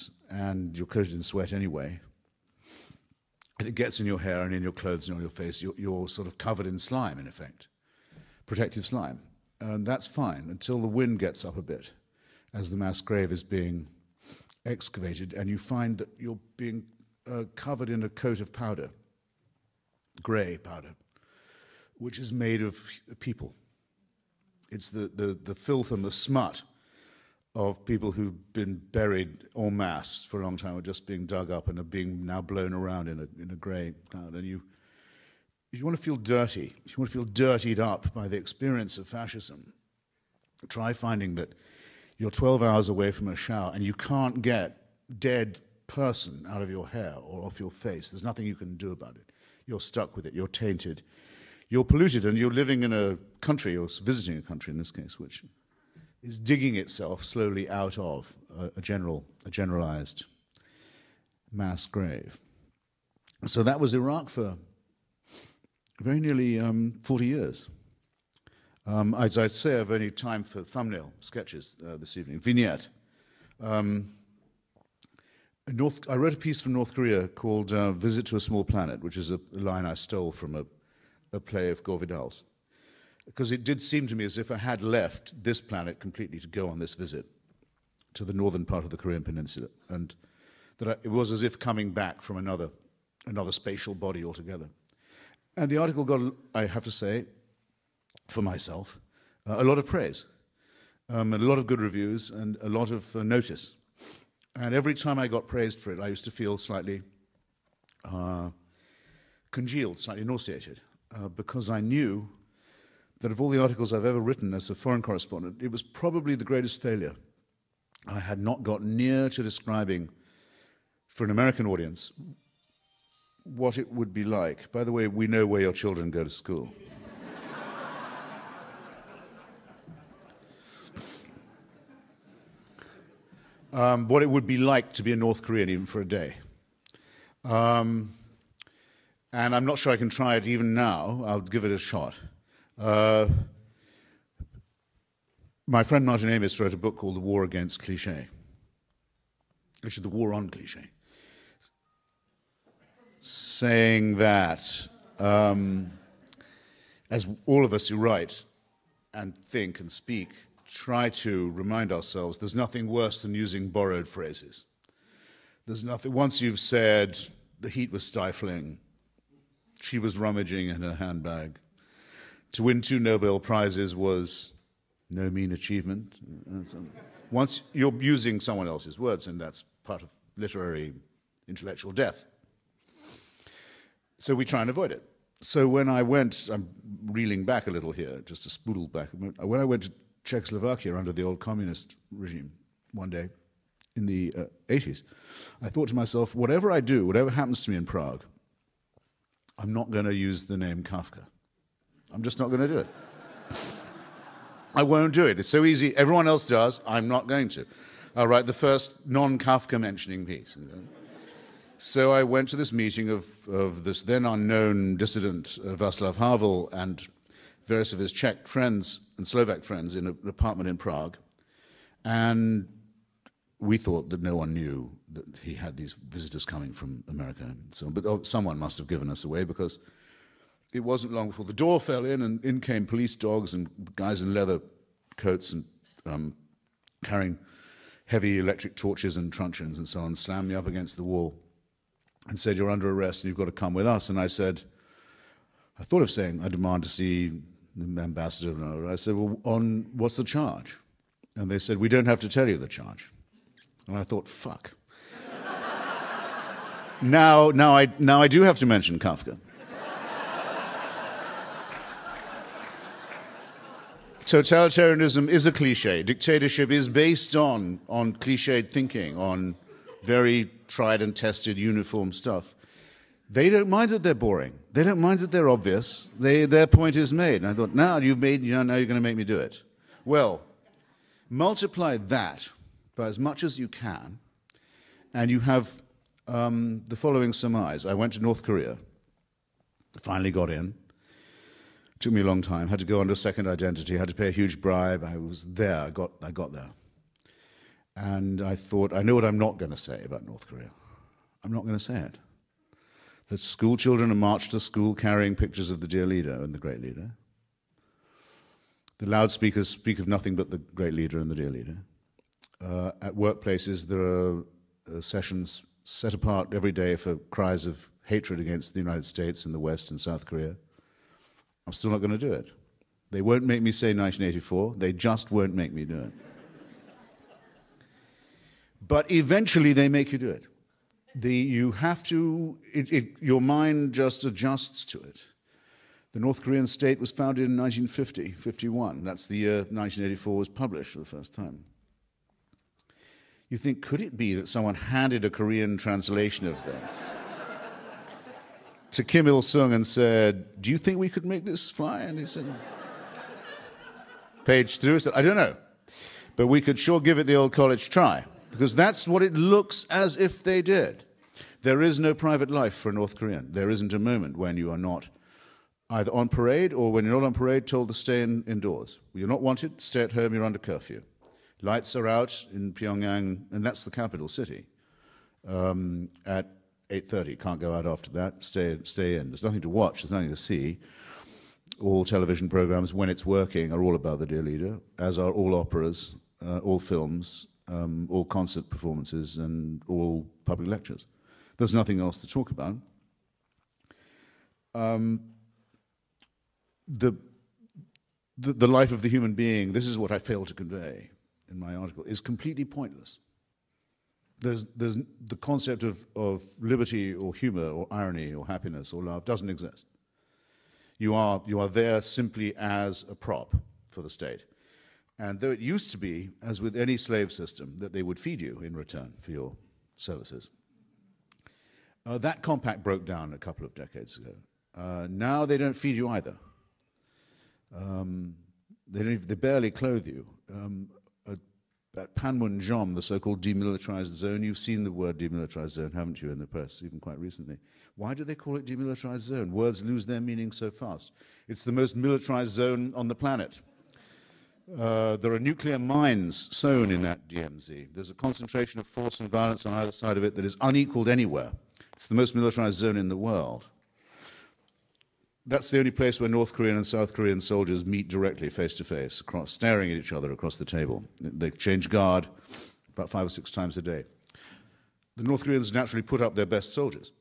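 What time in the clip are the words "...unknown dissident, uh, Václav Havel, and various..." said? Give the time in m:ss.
3:34.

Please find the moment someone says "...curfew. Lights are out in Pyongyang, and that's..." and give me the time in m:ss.
6:10.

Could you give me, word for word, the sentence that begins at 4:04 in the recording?
And I said, I thought of saying, I demand to see the ambassador.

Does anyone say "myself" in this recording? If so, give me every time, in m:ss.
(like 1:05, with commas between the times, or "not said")
1:38, 3:15.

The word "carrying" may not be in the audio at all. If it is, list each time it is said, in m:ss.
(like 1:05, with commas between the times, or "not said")
3:57, 5:04.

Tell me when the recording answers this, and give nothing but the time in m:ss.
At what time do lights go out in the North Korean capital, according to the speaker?
6:16.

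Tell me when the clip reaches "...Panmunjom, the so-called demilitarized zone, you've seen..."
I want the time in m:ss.
7:12.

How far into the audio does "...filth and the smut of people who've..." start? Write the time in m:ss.
0:25.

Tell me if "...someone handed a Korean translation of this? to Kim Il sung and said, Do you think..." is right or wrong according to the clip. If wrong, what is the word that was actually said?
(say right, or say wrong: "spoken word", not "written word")
right.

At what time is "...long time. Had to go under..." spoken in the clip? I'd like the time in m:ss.
4:52.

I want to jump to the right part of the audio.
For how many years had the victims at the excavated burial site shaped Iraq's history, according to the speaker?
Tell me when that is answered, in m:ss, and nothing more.
1:07.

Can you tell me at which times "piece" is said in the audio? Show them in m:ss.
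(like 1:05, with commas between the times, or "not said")
1:16, 3:30.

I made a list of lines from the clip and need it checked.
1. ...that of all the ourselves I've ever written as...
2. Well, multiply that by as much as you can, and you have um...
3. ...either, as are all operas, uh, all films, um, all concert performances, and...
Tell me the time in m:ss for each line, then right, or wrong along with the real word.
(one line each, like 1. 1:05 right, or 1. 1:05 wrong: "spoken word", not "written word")
1. 1:53 wrong: "articles", not "ourselves"
2. 4:40 right
3. 6:24 wrong: "leader", not "either".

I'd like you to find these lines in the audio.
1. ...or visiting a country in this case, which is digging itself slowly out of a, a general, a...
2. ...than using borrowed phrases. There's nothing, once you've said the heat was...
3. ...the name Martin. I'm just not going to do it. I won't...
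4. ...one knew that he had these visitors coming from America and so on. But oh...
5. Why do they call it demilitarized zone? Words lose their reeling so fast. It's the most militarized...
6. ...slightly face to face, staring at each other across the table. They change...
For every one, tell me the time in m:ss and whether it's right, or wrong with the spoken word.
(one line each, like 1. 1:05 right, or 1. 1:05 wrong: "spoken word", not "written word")
1. 0:53 right
2. 2:43 right
3. 3:20 wrong: "Kafka", not "Martin"
4. 3:44 right
5. 7:17 wrong: "meaning", not "reeling"
6. 7:38 wrong: "directly", not "slightly".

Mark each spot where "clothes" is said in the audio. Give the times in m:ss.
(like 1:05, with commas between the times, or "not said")
0:04, 7:09.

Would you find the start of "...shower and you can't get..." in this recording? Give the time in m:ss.
0:43.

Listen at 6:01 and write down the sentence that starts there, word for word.
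There is no private life for a North Korean.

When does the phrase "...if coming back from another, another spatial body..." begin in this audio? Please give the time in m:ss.
1:31.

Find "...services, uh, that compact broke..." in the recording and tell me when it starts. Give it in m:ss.
6:59.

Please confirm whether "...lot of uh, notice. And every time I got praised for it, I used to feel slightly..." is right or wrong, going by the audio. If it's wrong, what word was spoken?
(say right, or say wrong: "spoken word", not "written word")
right.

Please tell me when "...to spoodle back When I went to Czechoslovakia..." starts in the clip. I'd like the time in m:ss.
3:08.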